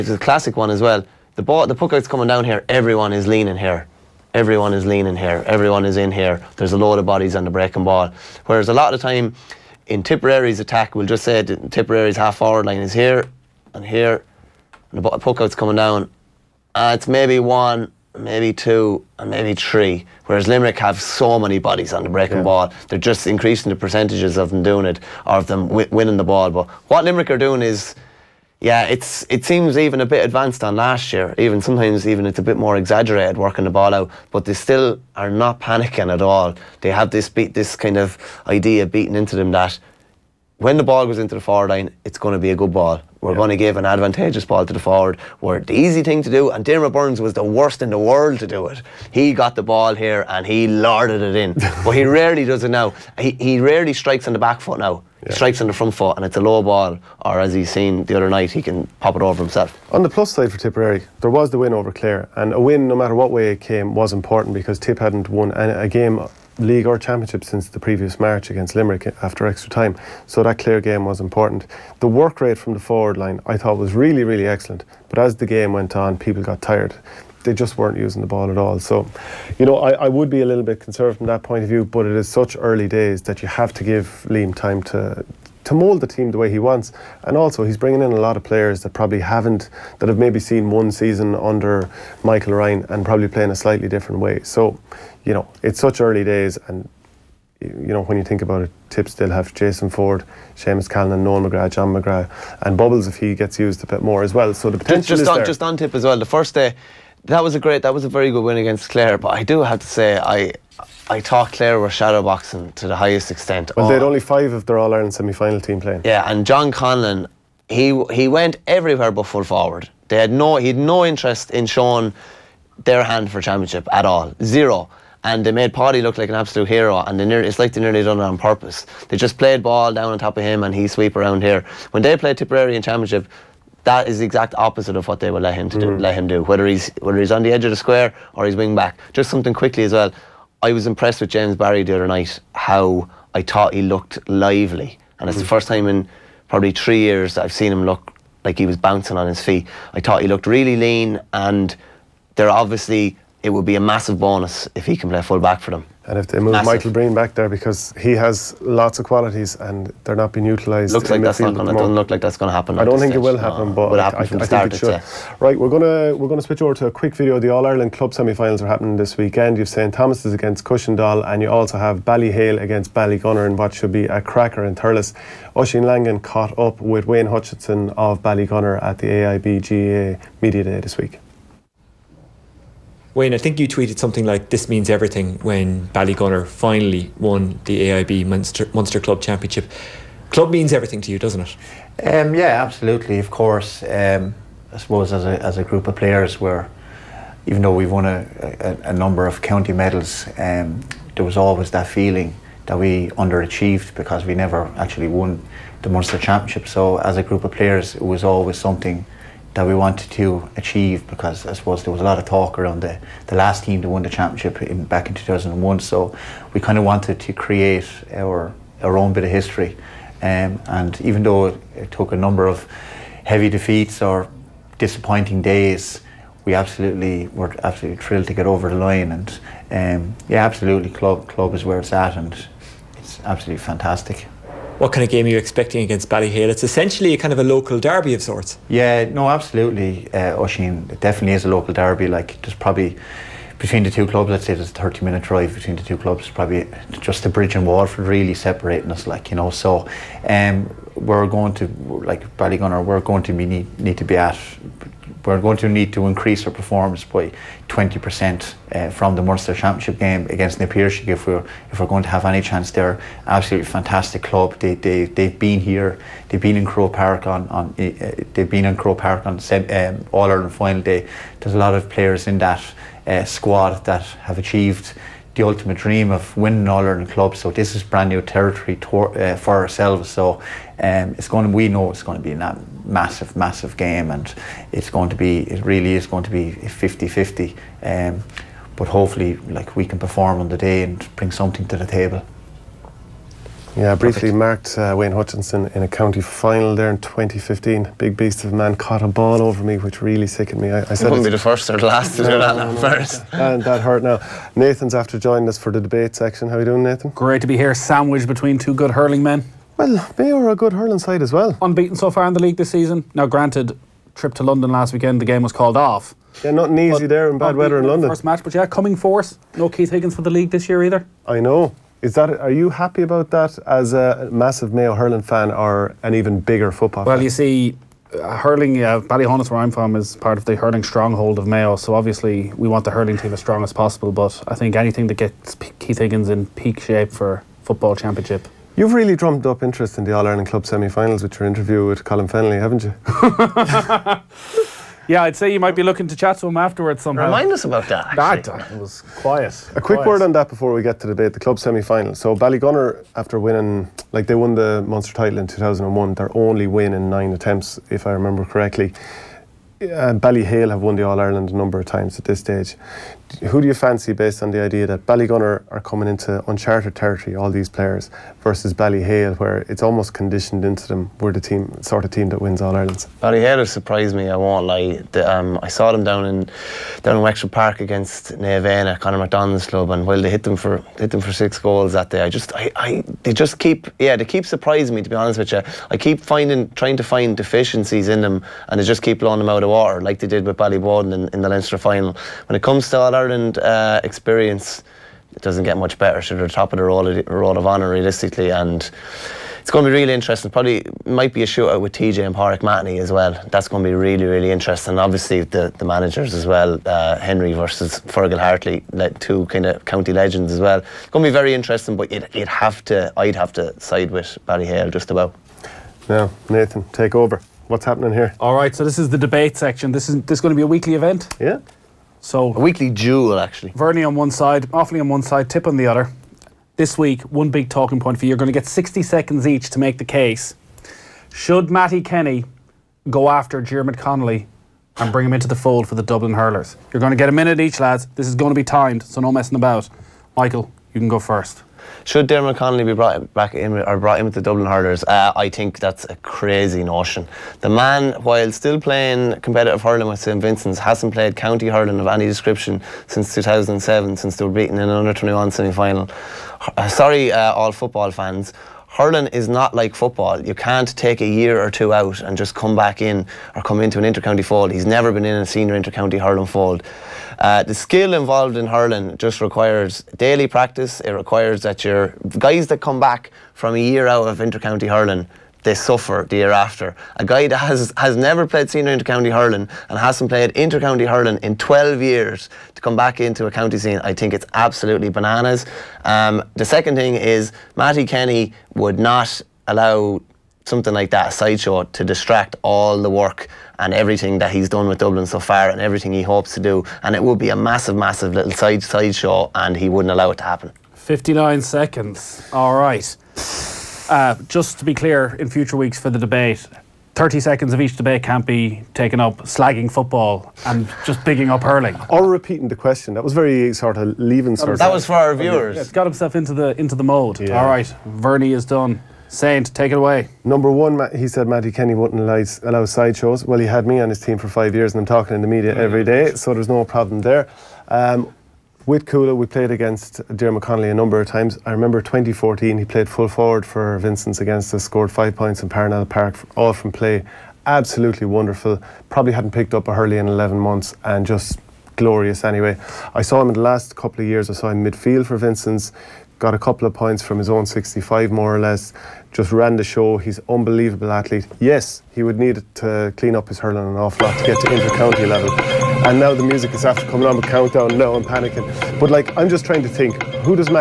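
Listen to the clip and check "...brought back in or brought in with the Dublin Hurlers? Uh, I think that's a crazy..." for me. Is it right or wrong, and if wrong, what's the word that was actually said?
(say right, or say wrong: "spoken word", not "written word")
right.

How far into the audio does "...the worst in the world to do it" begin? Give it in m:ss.
0:47.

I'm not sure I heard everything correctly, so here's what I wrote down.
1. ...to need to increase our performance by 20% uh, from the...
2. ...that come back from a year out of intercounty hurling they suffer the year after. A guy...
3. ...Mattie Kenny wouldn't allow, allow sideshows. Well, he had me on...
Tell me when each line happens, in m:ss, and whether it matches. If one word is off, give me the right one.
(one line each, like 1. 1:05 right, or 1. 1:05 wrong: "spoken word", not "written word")
1. 4:15 right
2. 7:52 right
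3. 8:41 right.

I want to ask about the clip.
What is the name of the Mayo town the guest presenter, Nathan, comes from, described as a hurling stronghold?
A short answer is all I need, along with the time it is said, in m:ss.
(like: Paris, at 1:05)
Ballyhaunis, at 5:28.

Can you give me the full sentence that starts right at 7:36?
Uh, sorry, uh, all football fans hurling is not like football.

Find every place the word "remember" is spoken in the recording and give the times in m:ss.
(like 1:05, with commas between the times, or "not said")
5:58, 8:51.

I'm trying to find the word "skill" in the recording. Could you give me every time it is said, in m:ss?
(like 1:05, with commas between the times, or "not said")
7:47.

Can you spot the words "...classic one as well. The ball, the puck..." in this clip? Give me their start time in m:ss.
0:00.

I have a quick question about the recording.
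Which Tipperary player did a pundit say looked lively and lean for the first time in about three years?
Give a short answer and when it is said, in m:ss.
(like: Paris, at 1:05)
James Barry, at 2:21.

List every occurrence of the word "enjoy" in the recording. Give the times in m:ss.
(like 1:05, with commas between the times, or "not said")
not said.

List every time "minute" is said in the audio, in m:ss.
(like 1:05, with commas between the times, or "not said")
4:05, 7:17.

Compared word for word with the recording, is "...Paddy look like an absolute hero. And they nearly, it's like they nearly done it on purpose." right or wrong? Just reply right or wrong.
right.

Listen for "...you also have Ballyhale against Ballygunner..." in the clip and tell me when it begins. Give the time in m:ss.
2:51.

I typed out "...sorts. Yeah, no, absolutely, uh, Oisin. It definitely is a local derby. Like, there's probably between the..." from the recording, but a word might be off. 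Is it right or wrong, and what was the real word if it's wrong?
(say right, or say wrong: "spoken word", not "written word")
right.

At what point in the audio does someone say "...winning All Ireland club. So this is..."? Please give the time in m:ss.
4:36.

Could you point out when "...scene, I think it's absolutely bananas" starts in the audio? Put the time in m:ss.
8:03.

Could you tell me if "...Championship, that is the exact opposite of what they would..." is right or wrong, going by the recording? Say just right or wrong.
right.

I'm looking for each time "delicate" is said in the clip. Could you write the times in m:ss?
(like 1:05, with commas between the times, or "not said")
not said.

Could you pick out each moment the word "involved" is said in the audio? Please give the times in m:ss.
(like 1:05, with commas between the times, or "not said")
7:48.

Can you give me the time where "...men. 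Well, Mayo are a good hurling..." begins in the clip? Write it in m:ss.
5:09.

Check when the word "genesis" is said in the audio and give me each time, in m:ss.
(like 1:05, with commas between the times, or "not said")
not said.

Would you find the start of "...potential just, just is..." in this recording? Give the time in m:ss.
1:44.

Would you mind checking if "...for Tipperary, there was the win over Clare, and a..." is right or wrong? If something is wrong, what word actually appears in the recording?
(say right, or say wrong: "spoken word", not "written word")
right.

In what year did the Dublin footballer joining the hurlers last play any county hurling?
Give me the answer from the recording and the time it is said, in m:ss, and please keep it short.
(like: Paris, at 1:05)
2007, at 7:33.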